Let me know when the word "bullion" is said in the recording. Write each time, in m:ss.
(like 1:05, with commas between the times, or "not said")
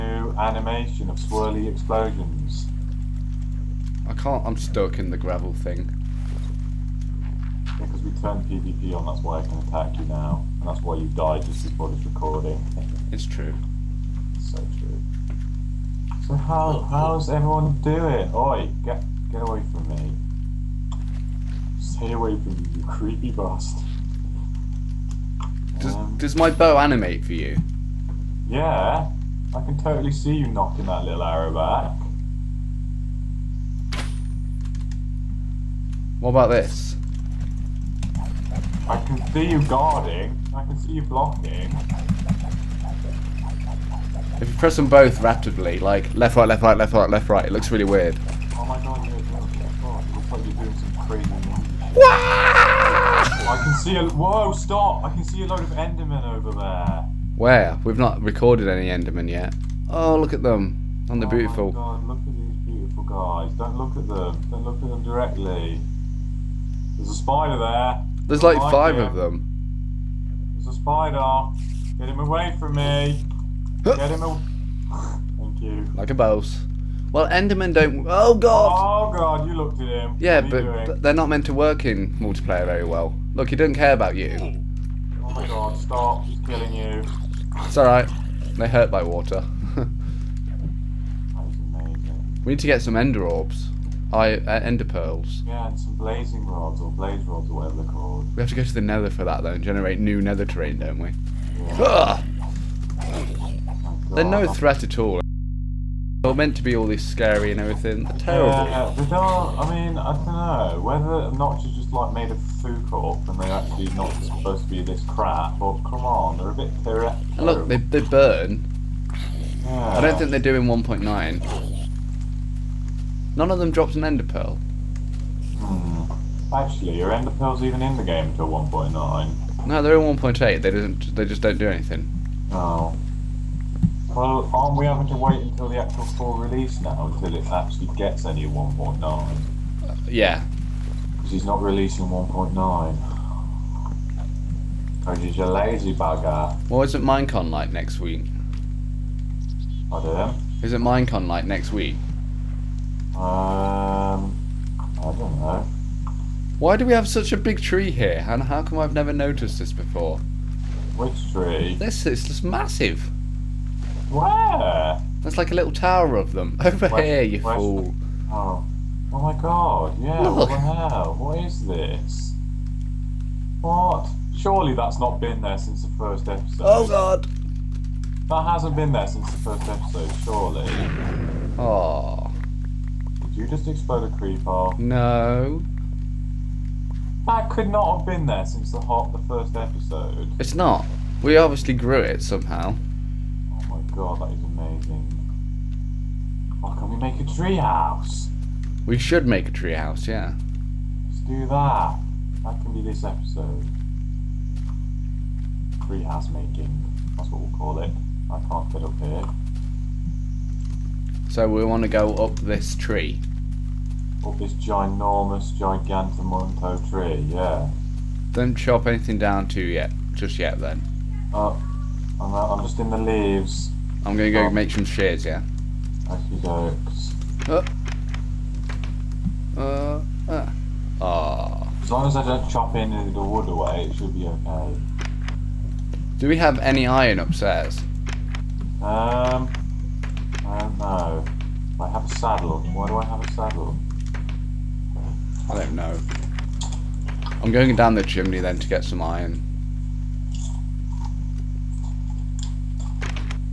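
not said.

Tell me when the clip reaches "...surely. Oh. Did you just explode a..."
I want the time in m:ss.
3:00.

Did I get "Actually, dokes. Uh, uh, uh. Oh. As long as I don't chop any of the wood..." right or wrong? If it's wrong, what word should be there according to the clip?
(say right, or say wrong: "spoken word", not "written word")
right.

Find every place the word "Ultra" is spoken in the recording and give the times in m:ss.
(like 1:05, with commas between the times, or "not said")
not said.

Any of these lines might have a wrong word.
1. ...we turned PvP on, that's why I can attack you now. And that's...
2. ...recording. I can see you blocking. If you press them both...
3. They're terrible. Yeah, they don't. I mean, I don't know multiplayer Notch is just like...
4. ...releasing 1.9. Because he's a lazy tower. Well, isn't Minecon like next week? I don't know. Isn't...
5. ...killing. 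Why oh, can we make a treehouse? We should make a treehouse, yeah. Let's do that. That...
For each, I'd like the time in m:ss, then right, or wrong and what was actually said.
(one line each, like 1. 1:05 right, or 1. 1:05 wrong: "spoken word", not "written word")
1. 0:08 right
2. 0:39 wrong: "guarding", not "recording"
3. 1:48 wrong: "whether", not "multiplayer"
4. 2:21 wrong: "bugger", not "tower"
5. 3:14 wrong: "amazing", not "killing".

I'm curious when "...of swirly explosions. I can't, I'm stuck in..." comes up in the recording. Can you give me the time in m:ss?
0:01.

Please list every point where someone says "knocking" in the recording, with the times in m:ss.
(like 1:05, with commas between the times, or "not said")
0:30.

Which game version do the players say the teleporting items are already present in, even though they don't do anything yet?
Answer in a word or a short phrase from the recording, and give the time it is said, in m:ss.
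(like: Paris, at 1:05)
1.8, at 2:10.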